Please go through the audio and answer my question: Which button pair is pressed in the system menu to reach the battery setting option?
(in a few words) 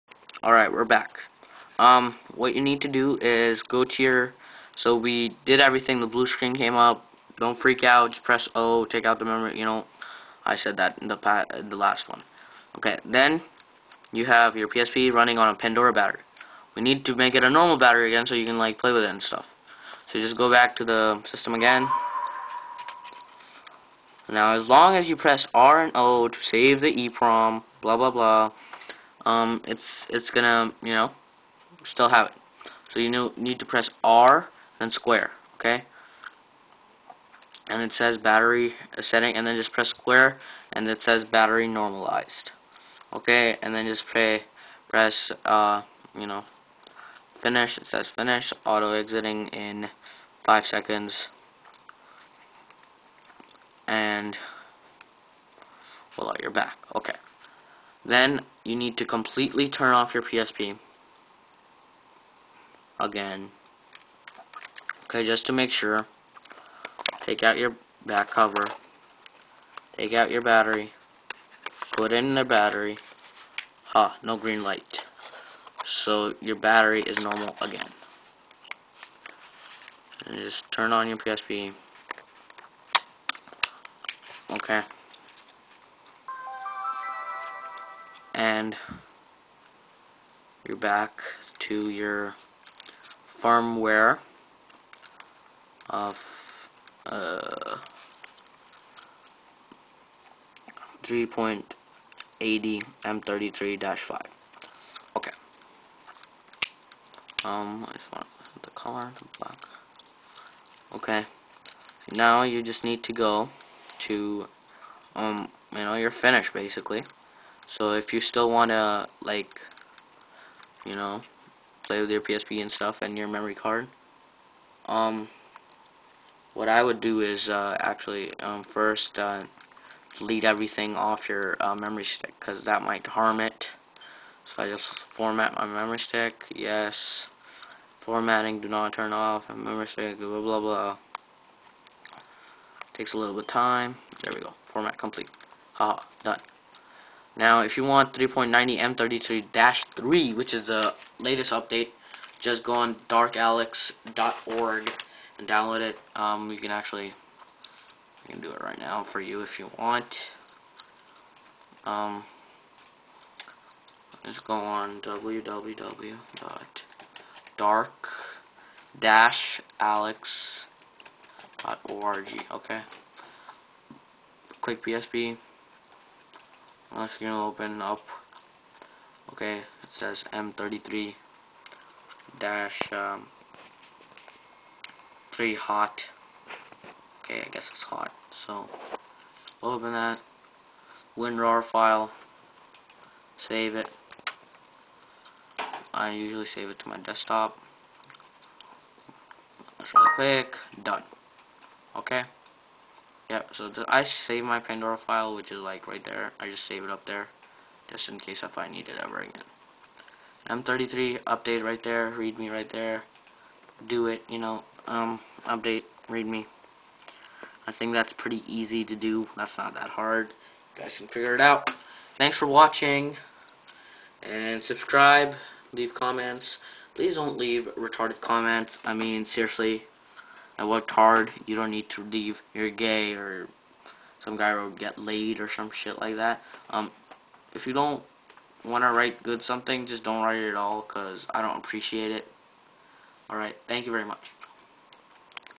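R and square.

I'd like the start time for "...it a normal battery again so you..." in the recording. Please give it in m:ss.
0:17.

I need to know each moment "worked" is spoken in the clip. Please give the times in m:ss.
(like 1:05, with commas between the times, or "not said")
3:50.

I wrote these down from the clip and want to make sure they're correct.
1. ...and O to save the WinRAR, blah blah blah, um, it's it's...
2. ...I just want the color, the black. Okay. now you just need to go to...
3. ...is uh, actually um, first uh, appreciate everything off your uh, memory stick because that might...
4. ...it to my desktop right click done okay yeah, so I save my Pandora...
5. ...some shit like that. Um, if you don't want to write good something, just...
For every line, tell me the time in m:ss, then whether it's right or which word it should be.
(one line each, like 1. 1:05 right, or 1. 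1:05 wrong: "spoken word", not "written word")
1. 0:25 wrong: "EEPROM", not "WinRAR"
2. 1:47 right
3. 2:07 wrong: "delete", not "appreciate"
4. 3:16 right
5. 3:55 right.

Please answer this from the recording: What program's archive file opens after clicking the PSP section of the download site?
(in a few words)
WinRAR.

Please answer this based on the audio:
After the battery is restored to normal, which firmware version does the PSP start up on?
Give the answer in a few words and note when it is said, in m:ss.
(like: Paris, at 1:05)
3.80 M33-5, at 1:41.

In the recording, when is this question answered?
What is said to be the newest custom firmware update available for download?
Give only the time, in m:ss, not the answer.
2:28.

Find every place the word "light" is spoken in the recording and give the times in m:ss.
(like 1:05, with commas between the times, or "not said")
1:14.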